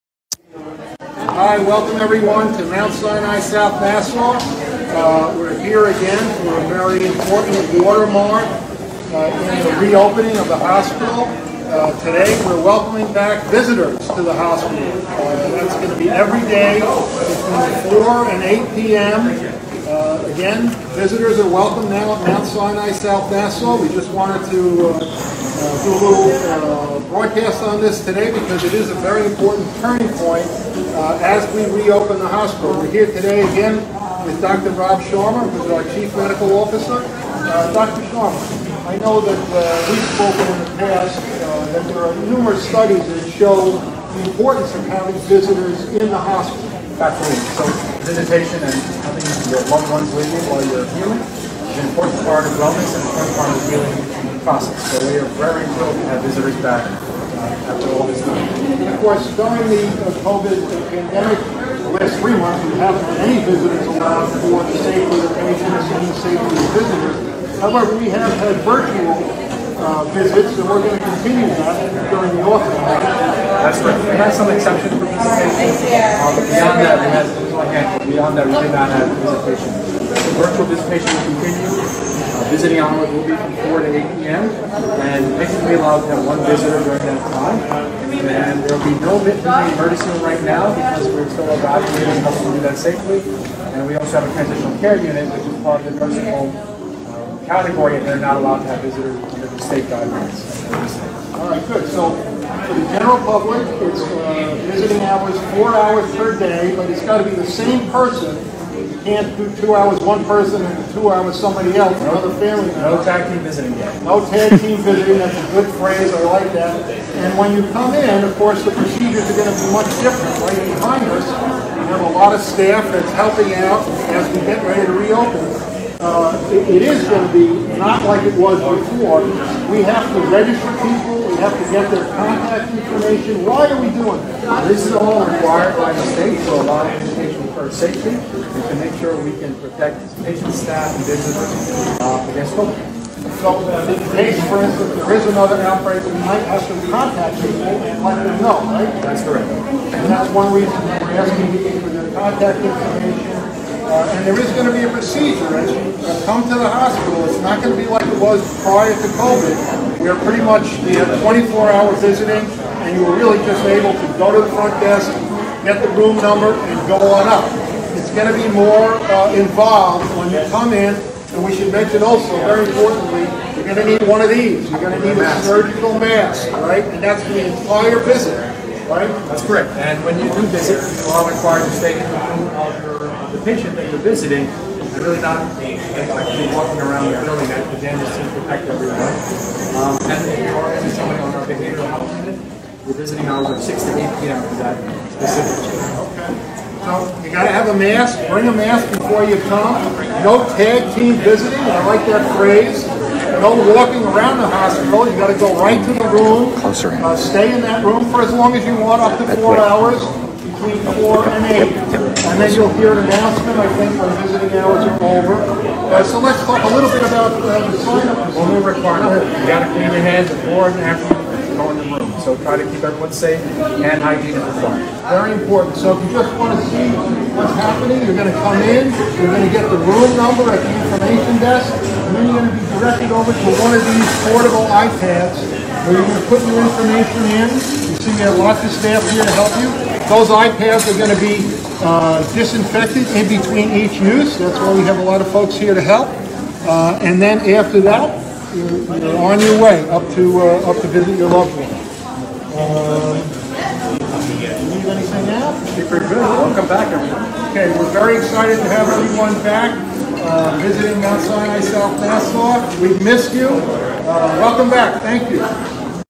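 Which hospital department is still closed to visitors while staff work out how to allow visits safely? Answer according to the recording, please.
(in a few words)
emergency room.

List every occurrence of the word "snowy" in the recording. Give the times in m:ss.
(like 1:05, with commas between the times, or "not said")
not said.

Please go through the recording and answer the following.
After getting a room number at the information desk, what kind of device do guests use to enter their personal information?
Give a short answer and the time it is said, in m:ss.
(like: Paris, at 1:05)
portable iPads, at 3:54.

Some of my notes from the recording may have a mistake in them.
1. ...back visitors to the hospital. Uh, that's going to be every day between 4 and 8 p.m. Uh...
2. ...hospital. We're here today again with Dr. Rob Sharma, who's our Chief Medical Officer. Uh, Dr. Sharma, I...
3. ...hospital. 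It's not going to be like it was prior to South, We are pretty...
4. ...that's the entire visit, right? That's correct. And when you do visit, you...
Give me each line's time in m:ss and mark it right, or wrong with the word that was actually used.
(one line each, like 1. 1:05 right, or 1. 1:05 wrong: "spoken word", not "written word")
1. 0:13 right
2. 0:32 right
3. 2:36 wrong: "COVID", not "South"
4. 2:57 right.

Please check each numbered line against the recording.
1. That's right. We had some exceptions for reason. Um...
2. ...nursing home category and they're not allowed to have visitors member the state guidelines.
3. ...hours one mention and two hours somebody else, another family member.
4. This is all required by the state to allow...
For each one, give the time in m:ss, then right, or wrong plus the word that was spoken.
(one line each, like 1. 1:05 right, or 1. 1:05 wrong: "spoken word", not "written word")
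1. 1:12 wrong: "visitation", not "reason"
2. 1:36 wrong: "under", not "member"
3. 1:49 wrong: "person", not "mention"
4. 2:14 right.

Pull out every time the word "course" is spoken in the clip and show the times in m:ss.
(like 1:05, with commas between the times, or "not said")
0:59, 1:58.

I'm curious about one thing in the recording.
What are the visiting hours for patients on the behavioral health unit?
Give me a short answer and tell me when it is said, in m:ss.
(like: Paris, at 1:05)
6 to 8 p.m., at 3:13.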